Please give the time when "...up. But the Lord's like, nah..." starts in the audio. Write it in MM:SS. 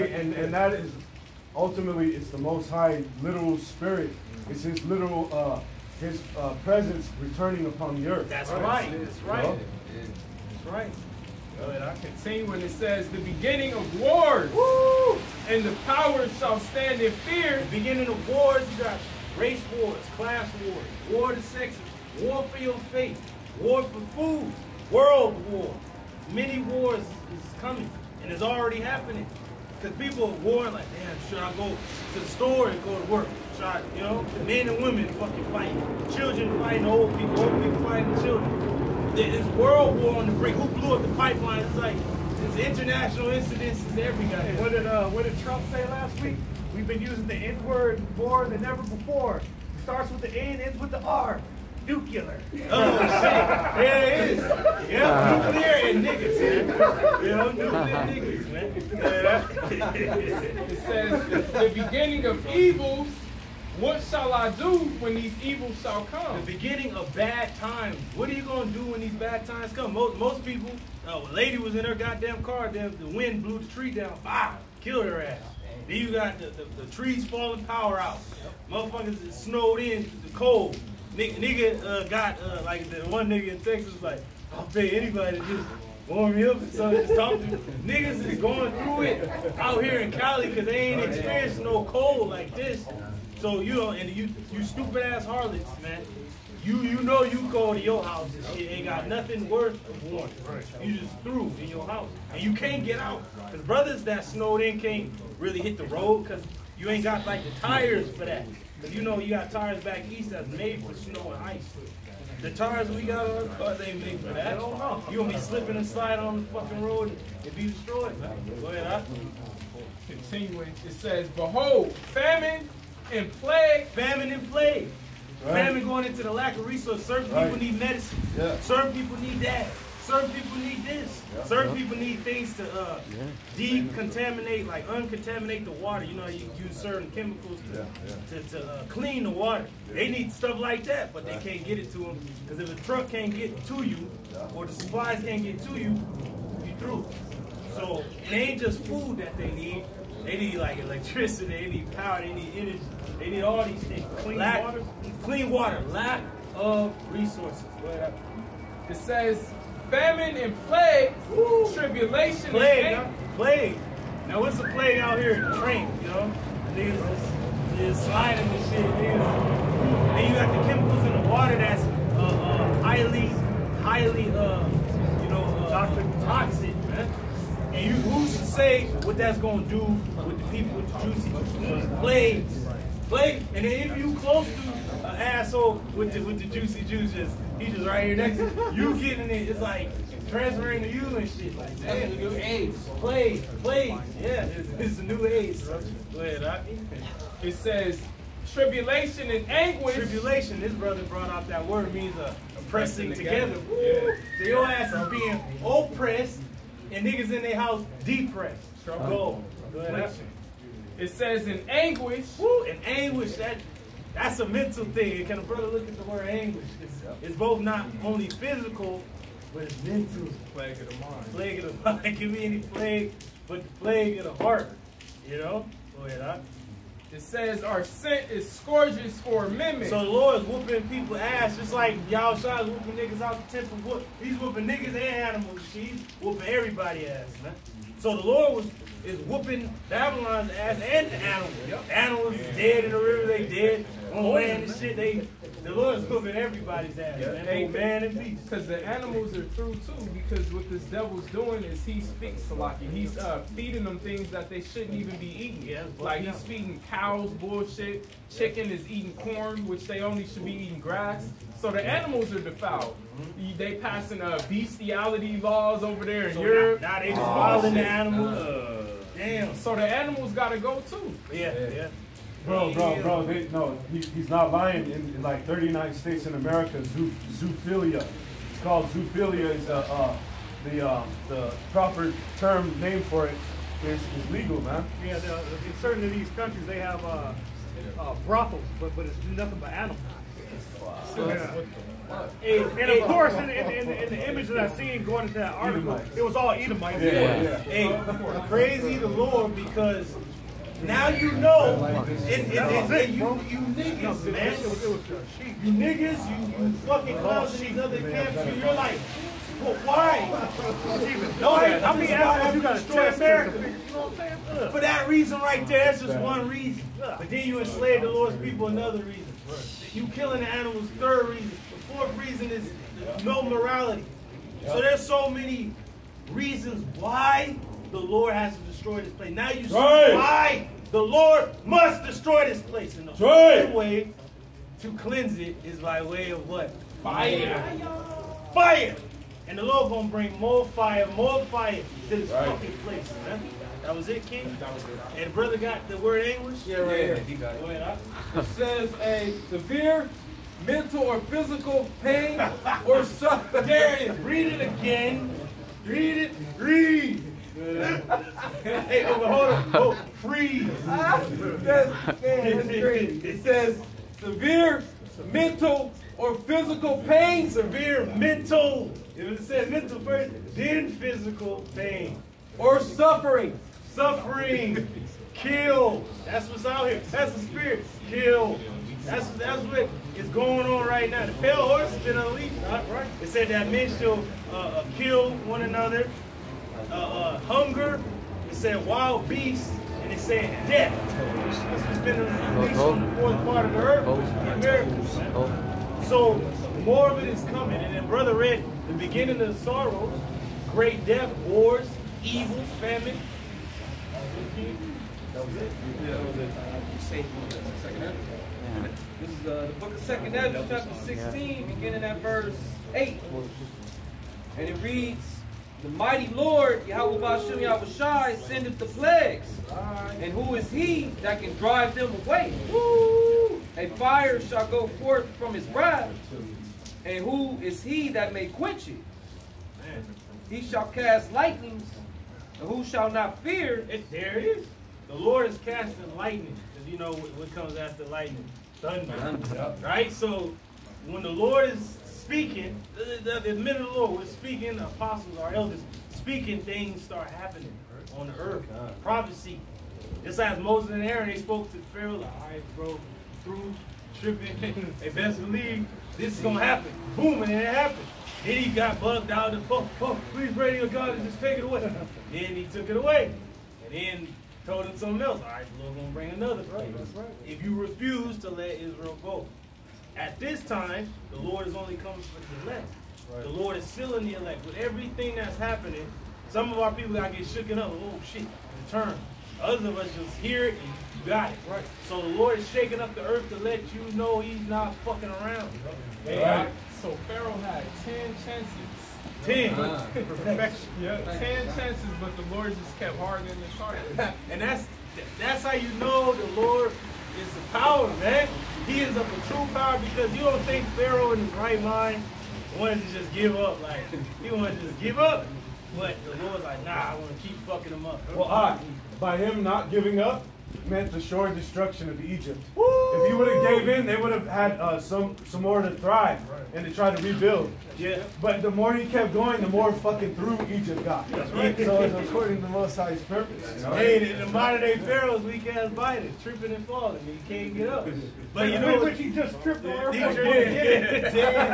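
08:25.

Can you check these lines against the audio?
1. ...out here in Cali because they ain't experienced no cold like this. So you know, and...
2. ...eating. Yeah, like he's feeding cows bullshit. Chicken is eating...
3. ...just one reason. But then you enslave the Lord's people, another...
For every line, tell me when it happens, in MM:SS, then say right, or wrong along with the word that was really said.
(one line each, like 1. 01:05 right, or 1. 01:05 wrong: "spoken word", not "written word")
1. 01:29 right
2. 04:15 right
3. 05:16 right.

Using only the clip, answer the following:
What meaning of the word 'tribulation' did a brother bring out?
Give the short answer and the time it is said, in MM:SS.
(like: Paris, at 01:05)
a pressing together, at 03:22.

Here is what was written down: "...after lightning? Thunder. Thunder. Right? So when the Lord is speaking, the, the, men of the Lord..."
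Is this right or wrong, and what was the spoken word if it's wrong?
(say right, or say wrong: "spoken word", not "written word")
right.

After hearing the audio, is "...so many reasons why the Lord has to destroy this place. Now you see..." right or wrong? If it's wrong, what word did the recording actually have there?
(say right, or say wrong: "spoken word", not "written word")
right.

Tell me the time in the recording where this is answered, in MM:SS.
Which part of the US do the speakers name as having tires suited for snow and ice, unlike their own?
01:49.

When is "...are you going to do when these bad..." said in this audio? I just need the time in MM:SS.
01:08.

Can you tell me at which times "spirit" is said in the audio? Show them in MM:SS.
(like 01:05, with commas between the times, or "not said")
00:03, 06:17.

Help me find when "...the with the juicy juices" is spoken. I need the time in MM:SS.
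03:06.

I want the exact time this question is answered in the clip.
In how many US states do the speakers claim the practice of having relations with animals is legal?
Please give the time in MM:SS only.
04:35.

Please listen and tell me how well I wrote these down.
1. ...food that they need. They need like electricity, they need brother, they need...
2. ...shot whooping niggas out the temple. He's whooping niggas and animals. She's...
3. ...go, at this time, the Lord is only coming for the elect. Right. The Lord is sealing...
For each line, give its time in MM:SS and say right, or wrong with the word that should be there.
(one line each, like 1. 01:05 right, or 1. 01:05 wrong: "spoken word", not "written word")
1. 02:28 wrong: "power", not "brother"
2. 03:52 right
3. 07:49 right.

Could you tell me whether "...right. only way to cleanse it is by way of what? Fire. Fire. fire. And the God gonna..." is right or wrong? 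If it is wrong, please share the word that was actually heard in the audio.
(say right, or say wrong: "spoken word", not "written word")
wrong: "Lord", not "God".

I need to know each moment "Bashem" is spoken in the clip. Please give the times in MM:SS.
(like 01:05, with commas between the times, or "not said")
06:57.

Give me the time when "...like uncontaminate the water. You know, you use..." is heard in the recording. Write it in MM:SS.
02:14.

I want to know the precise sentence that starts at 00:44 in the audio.
What did, uh, what did Trump say last week?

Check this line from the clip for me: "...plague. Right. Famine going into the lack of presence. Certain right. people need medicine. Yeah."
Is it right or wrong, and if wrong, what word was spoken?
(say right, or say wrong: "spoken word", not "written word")
wrong: "resource", not "presence".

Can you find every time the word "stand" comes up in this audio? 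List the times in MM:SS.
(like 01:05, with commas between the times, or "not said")
00:16.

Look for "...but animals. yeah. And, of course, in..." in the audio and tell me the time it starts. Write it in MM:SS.
04:49.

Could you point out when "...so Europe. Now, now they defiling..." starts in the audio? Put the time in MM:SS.
04:26.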